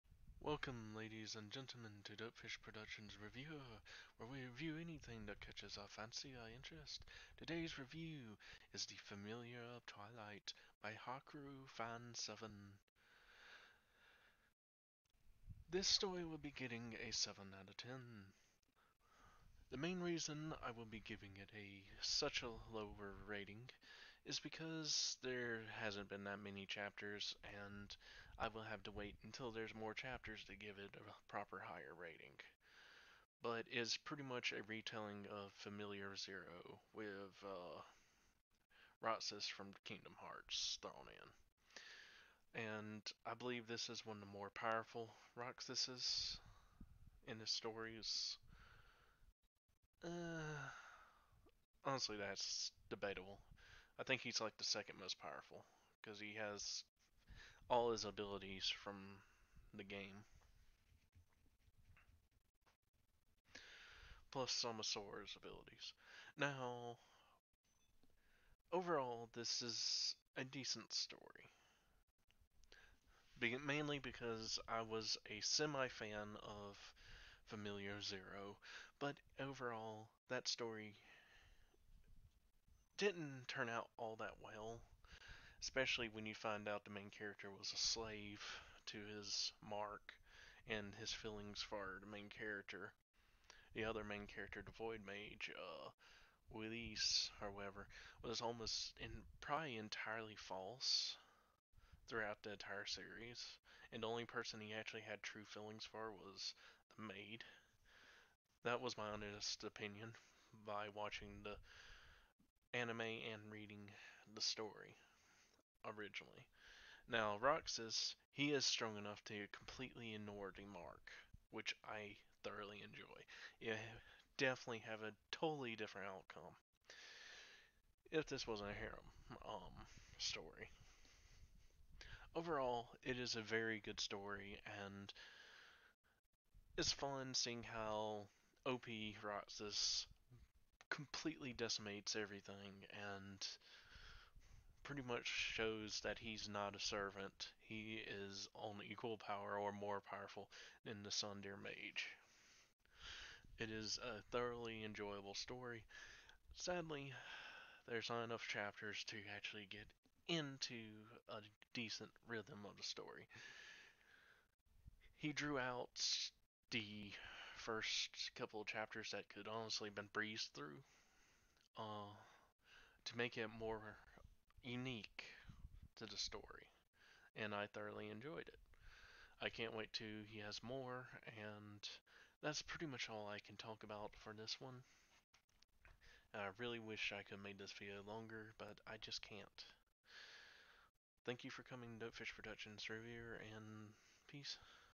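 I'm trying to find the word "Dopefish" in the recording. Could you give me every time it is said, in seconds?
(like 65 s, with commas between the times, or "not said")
2 s, 191 s.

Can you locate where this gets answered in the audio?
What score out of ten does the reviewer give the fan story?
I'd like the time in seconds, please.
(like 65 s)
17 s.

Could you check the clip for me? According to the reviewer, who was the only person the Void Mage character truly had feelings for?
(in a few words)
the maid.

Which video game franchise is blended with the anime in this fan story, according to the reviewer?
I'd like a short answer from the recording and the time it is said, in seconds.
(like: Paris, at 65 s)
Kingdom Hearts, at 39 s.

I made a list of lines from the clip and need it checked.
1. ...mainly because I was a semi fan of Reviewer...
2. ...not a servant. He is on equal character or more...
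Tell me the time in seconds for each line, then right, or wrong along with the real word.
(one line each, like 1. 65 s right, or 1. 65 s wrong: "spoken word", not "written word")
1. 73 s wrong: "Familiar", not "Reviewer"
2. 146 s wrong: "power", not "character".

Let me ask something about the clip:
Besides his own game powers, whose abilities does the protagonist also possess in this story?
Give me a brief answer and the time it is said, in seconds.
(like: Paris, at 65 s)
Sora's, at 64 s.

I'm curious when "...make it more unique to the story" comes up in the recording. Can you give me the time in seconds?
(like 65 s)
173 s.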